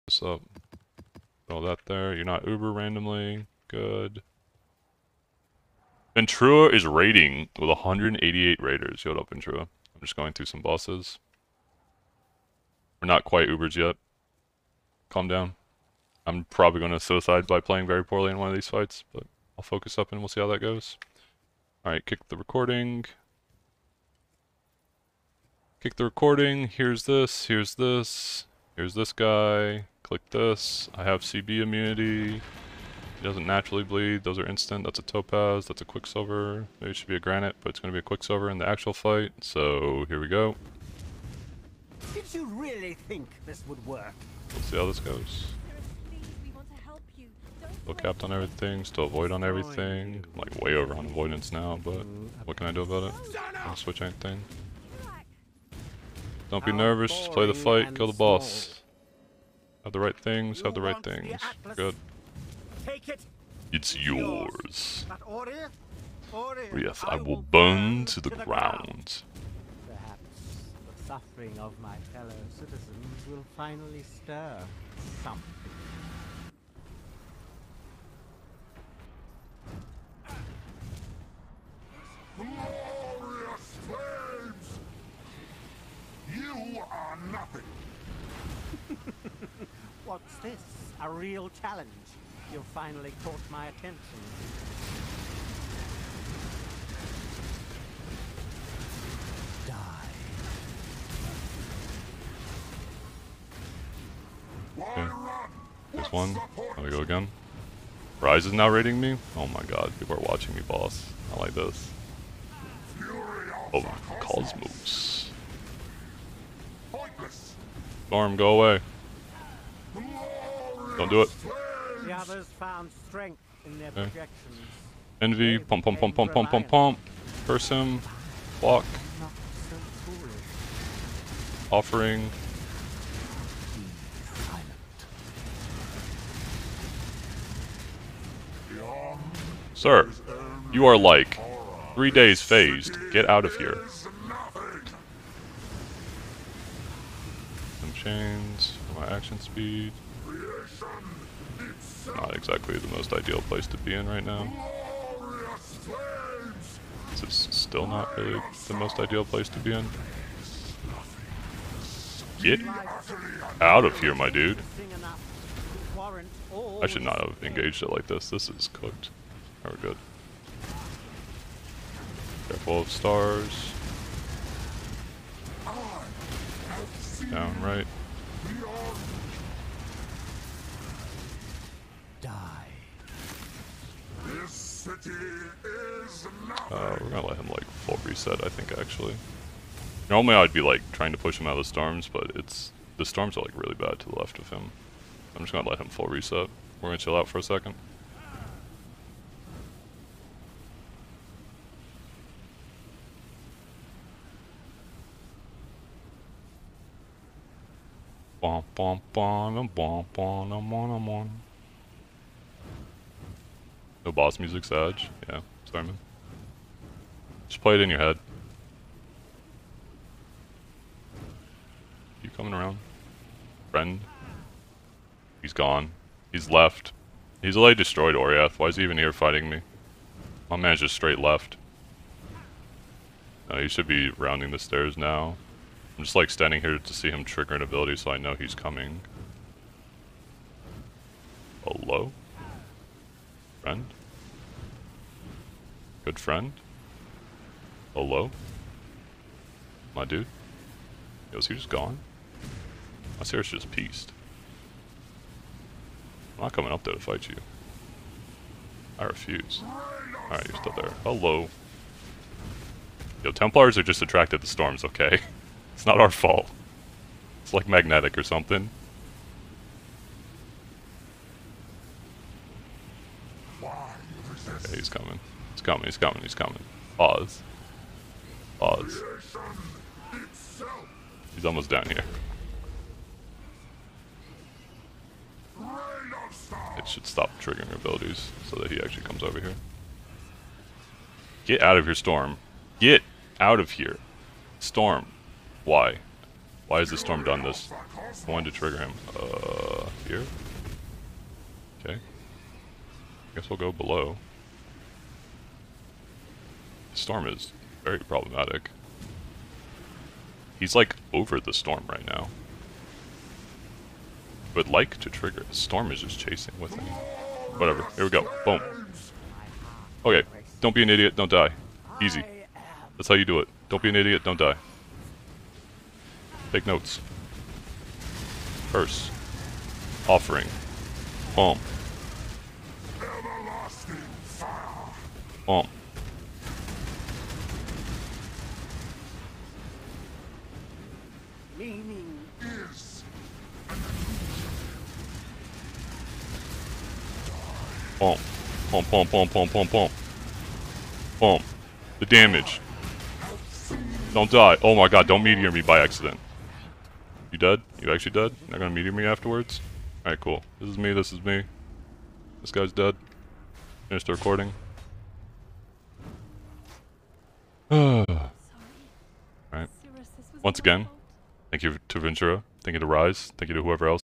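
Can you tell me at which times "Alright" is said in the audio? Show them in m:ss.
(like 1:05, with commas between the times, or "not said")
0:21, 4:20, 6:00, 6:07.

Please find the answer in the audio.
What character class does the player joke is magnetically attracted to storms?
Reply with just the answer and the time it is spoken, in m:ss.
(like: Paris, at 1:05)
Templars, at 4:23.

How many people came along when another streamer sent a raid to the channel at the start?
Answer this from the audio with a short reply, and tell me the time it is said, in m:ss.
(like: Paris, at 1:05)
188, at 0:07.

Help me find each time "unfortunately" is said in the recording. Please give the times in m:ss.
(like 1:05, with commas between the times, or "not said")
not said.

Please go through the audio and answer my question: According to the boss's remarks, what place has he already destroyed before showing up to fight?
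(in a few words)
Oriath.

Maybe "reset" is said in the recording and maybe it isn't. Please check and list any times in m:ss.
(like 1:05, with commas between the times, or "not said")
3:08, 3:16.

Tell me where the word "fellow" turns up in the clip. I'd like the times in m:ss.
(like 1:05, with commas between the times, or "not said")
1:12.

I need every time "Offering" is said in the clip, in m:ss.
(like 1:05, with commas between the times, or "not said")
2:11, 5:30.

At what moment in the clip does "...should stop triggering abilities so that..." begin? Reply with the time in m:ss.
4:46.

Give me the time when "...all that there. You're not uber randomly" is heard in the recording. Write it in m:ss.
0:01.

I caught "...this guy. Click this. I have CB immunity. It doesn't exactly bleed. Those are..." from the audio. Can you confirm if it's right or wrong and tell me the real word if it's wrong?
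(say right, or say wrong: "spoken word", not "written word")
wrong: "naturally", not "exactly".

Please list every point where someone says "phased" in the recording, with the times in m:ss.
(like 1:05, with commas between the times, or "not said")
2:22.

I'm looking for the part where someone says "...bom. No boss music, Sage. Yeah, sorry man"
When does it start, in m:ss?
3:31.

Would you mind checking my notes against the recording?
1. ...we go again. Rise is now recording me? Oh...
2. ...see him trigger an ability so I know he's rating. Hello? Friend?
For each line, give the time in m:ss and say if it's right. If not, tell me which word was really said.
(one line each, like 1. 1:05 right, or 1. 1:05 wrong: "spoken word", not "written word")
1. 1:46 wrong: "rating", not "recording"
2. 3:56 wrong: "coming", not "rating".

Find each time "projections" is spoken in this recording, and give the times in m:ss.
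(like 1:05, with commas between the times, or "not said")
2:04.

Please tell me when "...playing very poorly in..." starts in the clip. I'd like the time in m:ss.
0:17.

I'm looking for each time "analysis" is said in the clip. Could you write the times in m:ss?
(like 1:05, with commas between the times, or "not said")
not said.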